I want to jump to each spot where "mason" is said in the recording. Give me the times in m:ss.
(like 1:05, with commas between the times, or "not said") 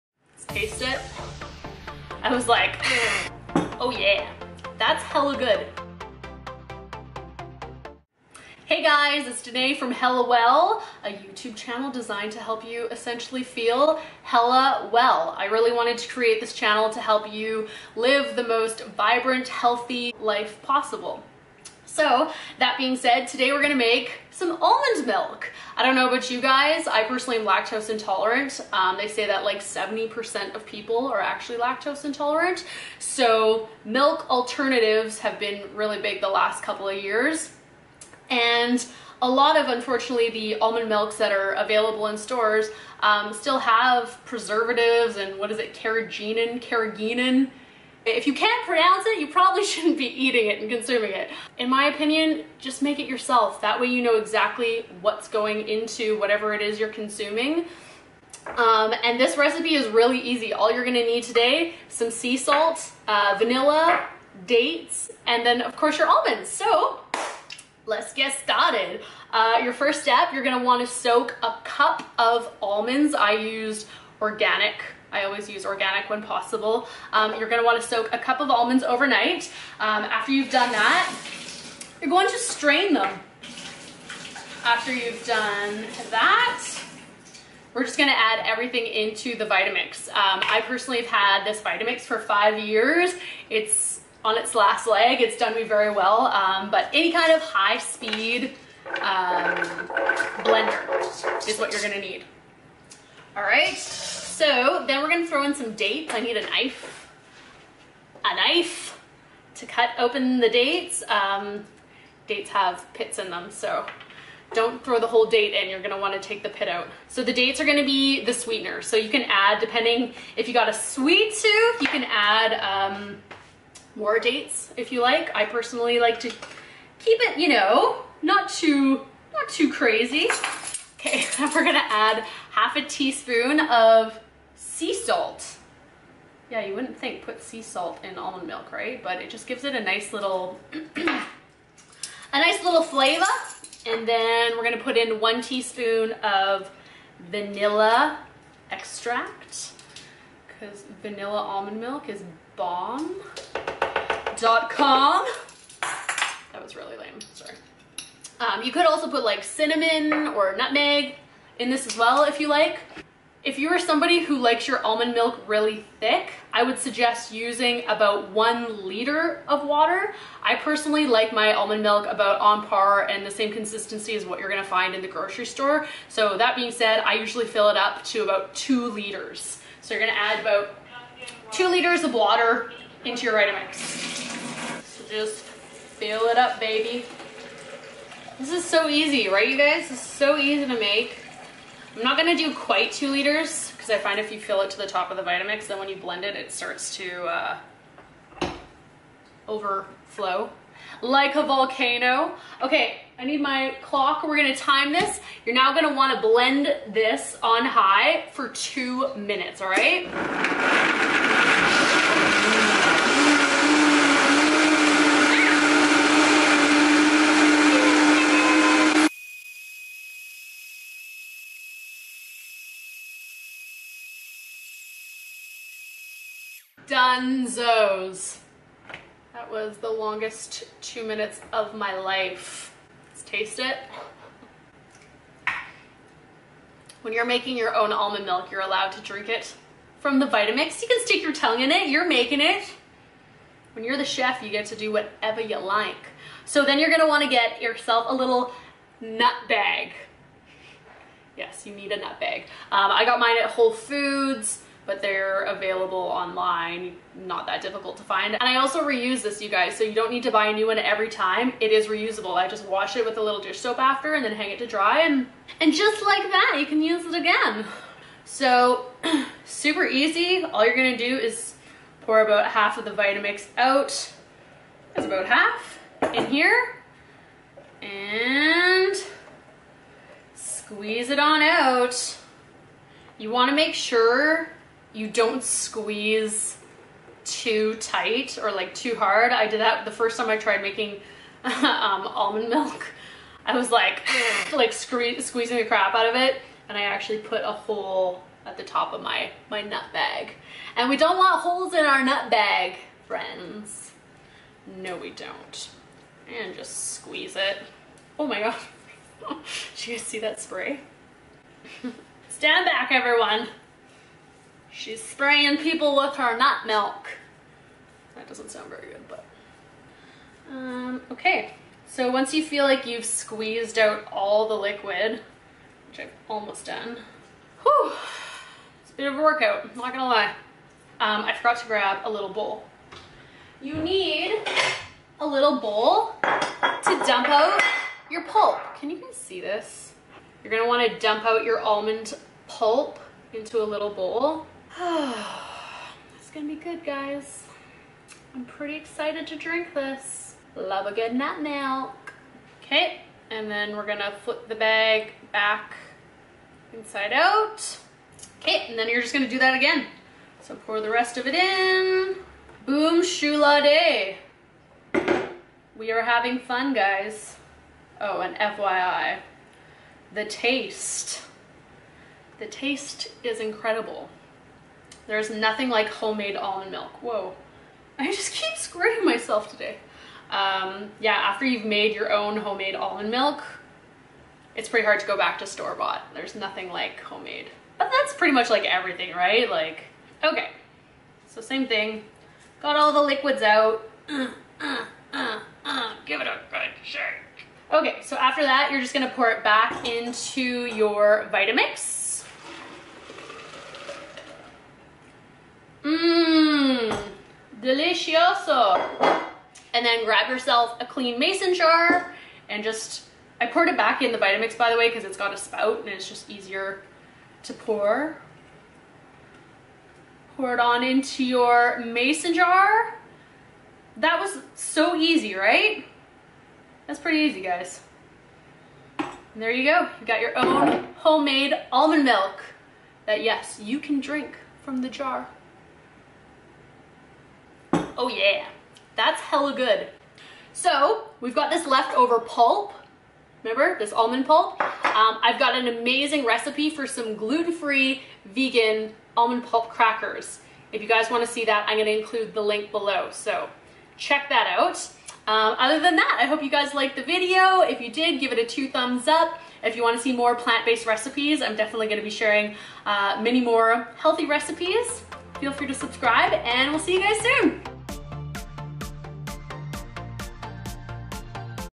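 6:51, 7:01.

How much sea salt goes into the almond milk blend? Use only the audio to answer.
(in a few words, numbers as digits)
half a teaspoon.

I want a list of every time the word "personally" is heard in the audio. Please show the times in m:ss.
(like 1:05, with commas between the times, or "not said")
0:27, 1:30, 2:05, 2:50.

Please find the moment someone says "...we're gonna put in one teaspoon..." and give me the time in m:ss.
2:24.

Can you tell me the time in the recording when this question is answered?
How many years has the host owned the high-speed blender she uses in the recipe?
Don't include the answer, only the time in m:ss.
1:32.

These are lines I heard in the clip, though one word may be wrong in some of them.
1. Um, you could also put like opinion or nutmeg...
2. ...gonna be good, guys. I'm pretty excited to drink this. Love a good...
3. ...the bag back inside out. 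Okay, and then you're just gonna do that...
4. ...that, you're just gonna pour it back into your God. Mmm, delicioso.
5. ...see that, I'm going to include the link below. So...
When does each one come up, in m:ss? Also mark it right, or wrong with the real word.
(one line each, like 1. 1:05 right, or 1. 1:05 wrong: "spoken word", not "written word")
1. 2:38 wrong: "cinnamon", not "opinion"
2. 5:46 right
3. 5:54 right
4. 6:38 wrong: "Vitamix", not "God"
5. 7:31 right.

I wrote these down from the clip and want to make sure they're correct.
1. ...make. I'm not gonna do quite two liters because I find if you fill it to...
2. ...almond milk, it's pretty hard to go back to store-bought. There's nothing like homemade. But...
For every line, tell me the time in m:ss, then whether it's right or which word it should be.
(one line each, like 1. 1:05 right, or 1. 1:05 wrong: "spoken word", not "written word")
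1. 3:10 right
2. 6:22 right.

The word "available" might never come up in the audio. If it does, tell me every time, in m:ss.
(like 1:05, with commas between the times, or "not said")
0:41, 4:15.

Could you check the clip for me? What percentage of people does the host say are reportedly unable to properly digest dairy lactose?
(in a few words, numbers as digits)
70%.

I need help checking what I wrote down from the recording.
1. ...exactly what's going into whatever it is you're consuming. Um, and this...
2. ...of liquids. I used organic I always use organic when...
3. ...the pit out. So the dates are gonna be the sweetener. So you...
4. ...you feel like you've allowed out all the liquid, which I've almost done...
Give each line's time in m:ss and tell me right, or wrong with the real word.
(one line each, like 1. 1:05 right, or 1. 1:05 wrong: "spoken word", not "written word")
1. 0:54 right
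2. 1:12 wrong: "almonds", not "liquids"
3. 1:56 right
4. 5:22 wrong: "squeezed", not "allowed".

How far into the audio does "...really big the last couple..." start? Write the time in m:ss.
0:35.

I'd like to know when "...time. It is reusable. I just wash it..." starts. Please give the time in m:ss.
4:21.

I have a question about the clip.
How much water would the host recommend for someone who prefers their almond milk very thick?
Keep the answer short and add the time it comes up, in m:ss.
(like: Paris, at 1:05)
1 liter, at 2:48.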